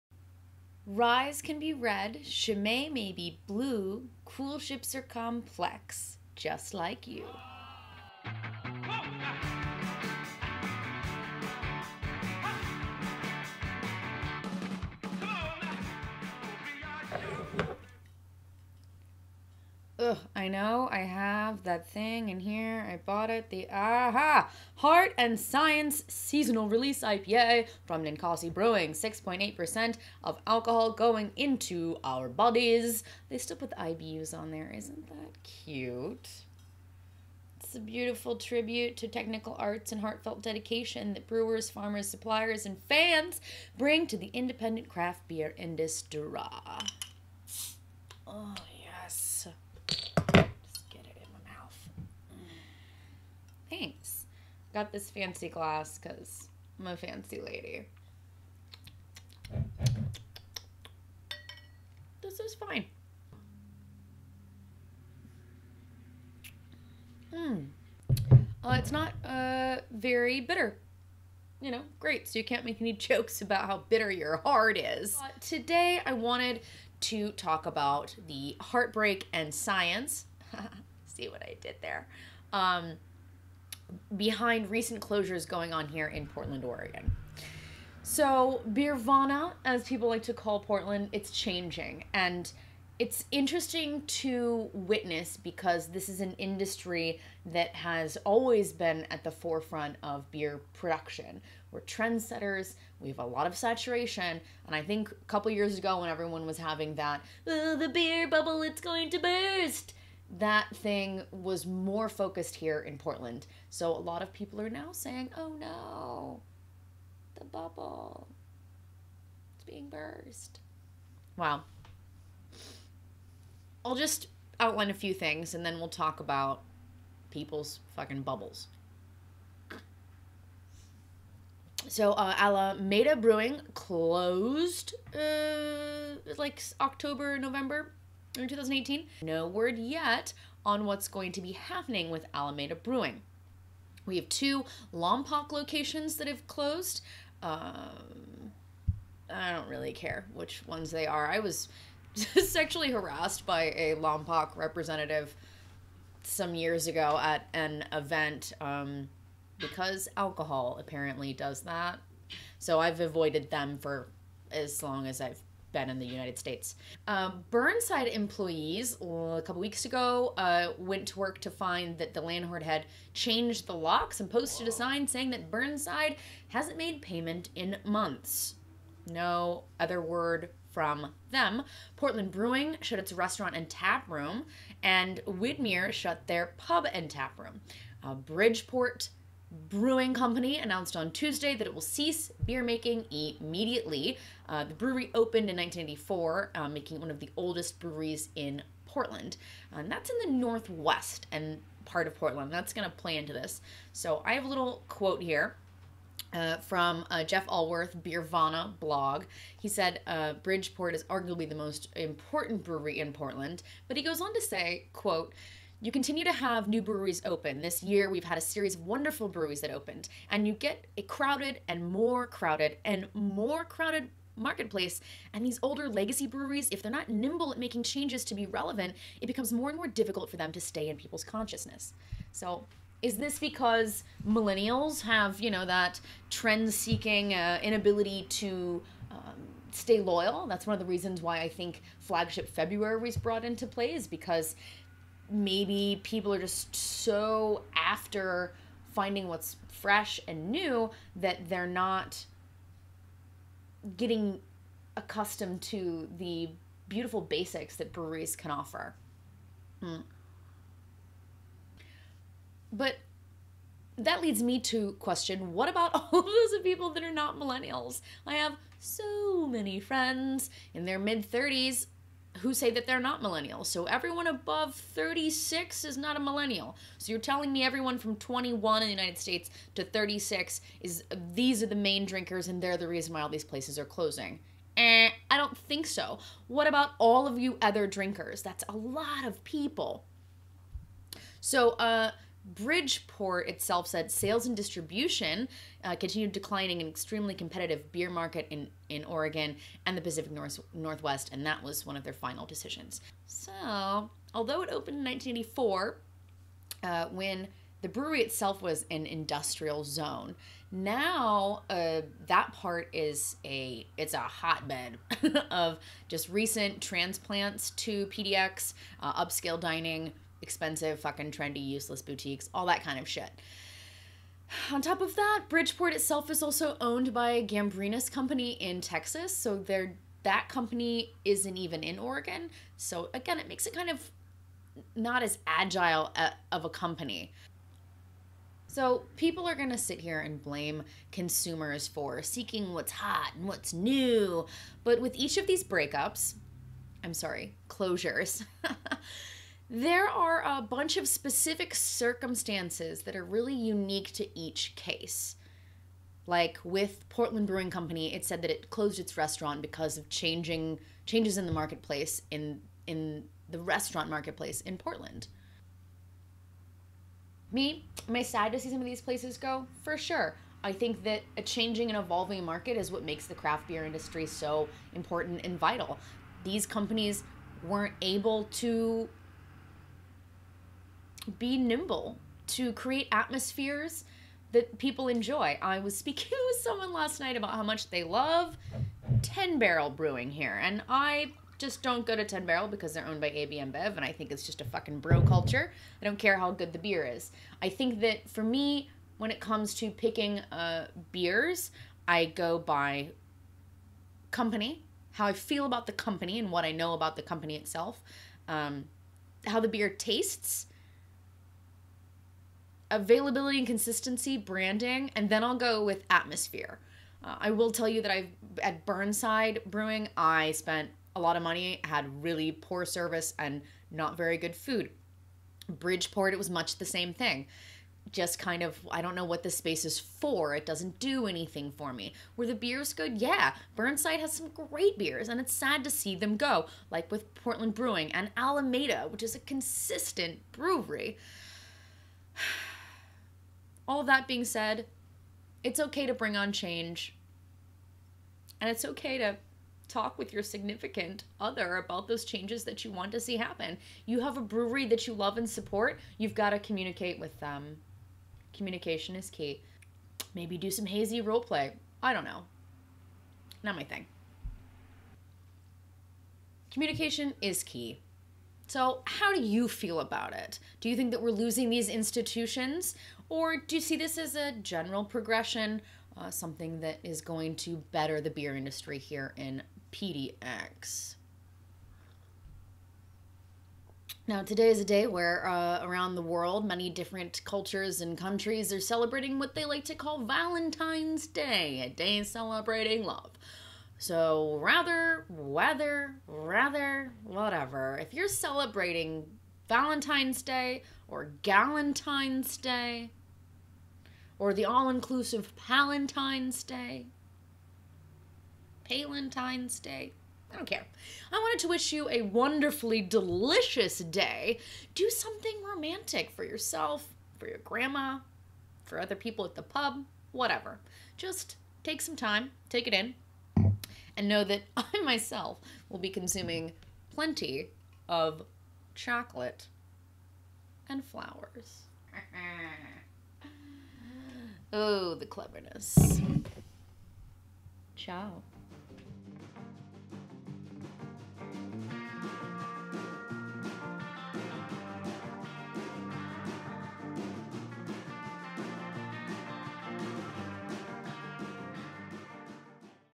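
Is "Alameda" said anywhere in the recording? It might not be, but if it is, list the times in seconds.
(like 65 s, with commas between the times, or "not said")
132 s, 142 s, 438 s.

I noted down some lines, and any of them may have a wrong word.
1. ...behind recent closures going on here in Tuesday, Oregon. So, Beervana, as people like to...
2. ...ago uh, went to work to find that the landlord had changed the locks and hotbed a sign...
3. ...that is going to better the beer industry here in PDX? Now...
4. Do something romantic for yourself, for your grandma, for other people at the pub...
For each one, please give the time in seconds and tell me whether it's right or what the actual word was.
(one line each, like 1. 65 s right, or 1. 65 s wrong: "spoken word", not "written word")
1. 84 s wrong: "Portland", not "Tuesday"
2. 169 s wrong: "posted", not "hotbed"
3. 476 s right
4. 514 s right.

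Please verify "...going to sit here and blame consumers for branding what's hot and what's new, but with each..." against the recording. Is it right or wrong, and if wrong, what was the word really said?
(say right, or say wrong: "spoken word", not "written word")
wrong: "seeking", not "branding".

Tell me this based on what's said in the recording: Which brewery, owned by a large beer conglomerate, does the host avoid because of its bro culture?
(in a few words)
10 Barrel Brewing.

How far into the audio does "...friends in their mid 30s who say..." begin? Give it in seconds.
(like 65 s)
269 s.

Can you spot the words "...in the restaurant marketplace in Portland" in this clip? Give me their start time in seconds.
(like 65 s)
362 s.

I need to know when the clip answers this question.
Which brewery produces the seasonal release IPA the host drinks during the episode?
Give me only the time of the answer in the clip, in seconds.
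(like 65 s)
28 s.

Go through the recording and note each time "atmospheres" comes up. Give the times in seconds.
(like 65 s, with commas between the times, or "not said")
383 s, 416 s.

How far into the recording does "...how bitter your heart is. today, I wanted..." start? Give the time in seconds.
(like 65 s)
73 s.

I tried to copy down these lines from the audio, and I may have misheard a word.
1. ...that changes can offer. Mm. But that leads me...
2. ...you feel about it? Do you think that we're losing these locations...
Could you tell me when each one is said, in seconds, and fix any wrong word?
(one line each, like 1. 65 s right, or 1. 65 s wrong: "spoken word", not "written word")
1. 257 s wrong: "breweries", not "changes"
2. 469 s wrong: "institutions", not "locations".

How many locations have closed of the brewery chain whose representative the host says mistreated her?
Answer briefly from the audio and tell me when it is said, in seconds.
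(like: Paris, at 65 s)
2, at 144 s.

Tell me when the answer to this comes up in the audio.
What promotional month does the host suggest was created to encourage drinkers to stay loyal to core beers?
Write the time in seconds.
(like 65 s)
242 s.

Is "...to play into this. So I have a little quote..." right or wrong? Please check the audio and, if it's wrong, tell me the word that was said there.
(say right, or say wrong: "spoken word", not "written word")
right.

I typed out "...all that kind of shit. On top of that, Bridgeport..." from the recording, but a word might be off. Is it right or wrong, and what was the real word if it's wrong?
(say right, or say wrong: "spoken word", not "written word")
right.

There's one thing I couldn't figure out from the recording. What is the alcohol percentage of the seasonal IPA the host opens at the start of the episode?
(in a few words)
6.8%.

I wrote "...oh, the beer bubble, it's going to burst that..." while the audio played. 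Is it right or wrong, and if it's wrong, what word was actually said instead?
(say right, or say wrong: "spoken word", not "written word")
right.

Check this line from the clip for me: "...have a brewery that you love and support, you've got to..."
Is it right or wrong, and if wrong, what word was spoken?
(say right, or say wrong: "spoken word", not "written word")
right.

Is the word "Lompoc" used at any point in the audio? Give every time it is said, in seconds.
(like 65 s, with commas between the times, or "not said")
144 s, 153 s.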